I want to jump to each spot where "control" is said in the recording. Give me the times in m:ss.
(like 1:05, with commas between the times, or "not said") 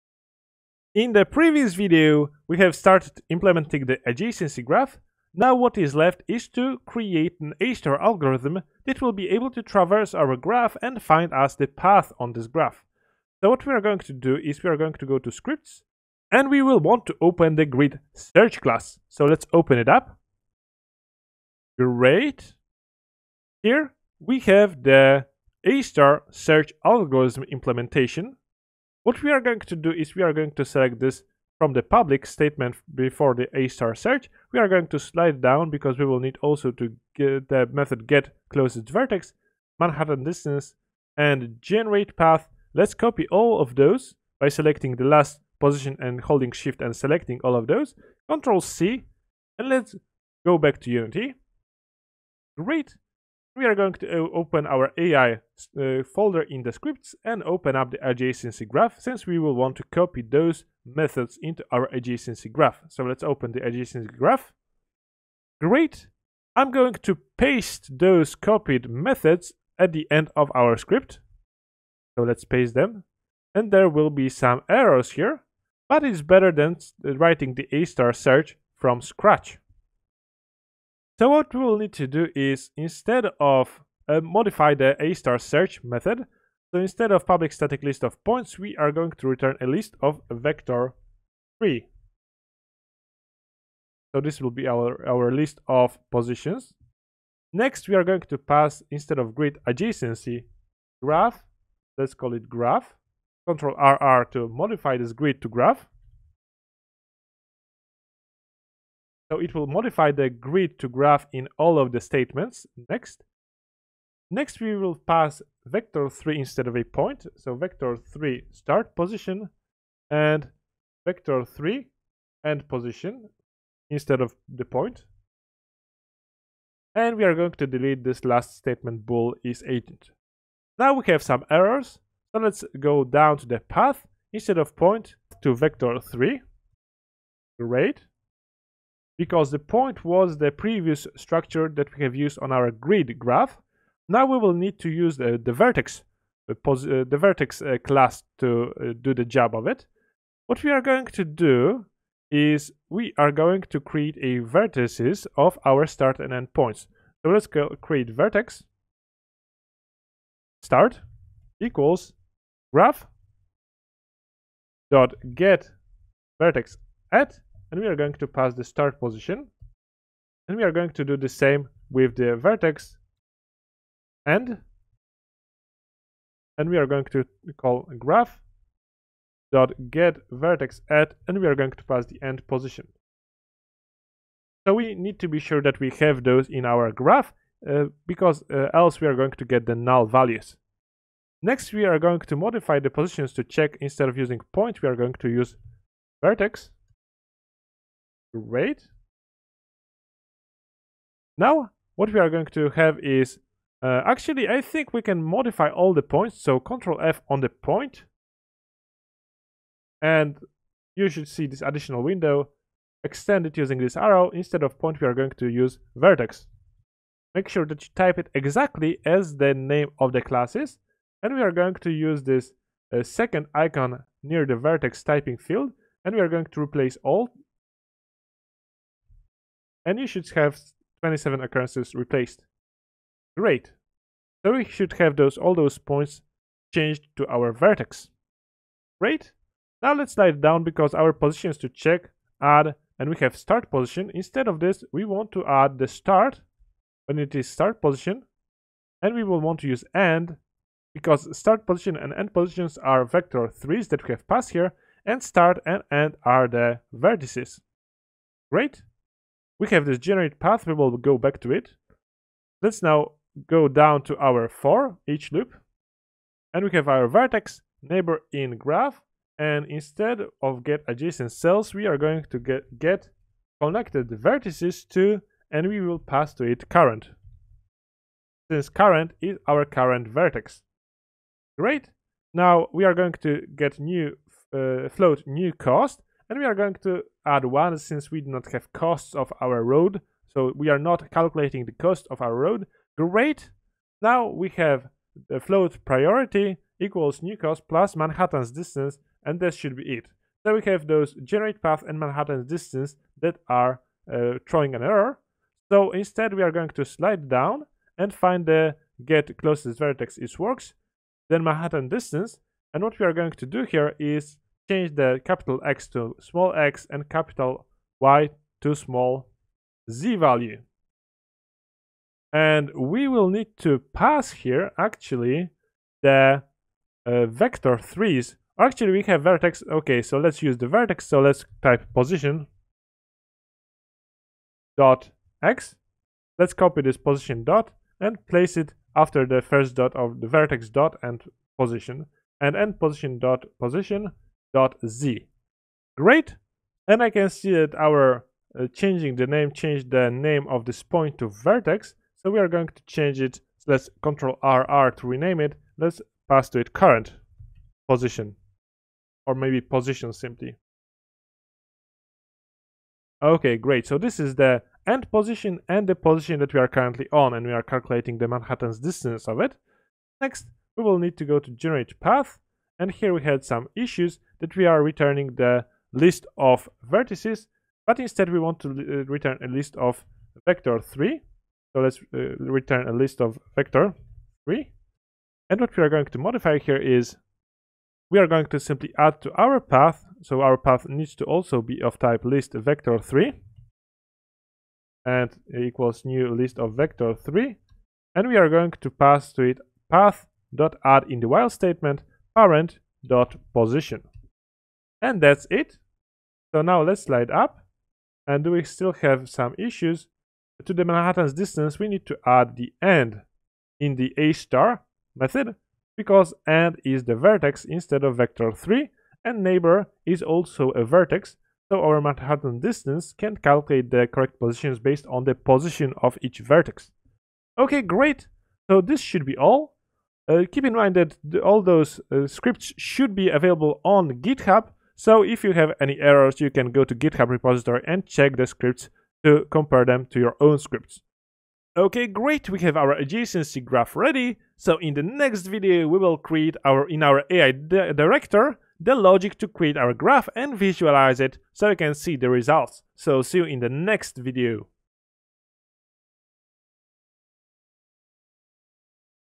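0:48, 1:43, 3:26, 5:54.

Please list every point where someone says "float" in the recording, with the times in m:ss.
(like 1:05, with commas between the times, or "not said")
4:44, 4:55.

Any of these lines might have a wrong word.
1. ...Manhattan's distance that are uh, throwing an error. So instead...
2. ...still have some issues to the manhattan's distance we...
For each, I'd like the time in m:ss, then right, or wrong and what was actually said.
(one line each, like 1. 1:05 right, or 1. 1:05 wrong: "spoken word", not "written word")
1. 5:01 right
2. 6:48 right.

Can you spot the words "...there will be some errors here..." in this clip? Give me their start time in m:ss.
1:13.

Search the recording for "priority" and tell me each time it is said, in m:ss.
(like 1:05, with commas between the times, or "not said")
4:55.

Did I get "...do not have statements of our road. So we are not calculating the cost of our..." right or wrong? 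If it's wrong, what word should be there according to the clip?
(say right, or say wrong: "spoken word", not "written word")
wrong: "costs", not "statements".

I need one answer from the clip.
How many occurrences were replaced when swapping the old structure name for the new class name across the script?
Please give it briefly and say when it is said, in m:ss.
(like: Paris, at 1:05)
27, at 3:51.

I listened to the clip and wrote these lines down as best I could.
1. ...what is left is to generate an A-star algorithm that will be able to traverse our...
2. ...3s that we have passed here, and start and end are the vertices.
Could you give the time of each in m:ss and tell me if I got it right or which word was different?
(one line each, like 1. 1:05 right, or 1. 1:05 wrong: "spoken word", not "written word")
1. 0:05 wrong: "create", not "generate"
2. 4:13 right.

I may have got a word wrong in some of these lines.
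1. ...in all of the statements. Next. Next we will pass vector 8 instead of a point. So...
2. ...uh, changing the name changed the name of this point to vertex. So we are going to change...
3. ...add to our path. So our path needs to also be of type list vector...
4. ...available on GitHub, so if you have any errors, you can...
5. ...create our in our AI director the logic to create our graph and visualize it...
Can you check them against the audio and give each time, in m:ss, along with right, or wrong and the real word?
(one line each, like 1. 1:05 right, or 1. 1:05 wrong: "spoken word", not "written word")
1. 1:51 wrong: "3", not "8"
2. 5:48 right
3. 6:28 right
4. 7:13 right
5. 7:26 right.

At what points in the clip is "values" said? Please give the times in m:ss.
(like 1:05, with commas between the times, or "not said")
3:10, 5:20.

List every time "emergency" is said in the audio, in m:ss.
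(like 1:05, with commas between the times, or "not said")
not said.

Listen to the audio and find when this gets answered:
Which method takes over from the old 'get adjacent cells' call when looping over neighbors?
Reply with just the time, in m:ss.
4:32.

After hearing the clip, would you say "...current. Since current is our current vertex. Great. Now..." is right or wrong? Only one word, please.
right.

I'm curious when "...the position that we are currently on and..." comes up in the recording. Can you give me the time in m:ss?
6:05.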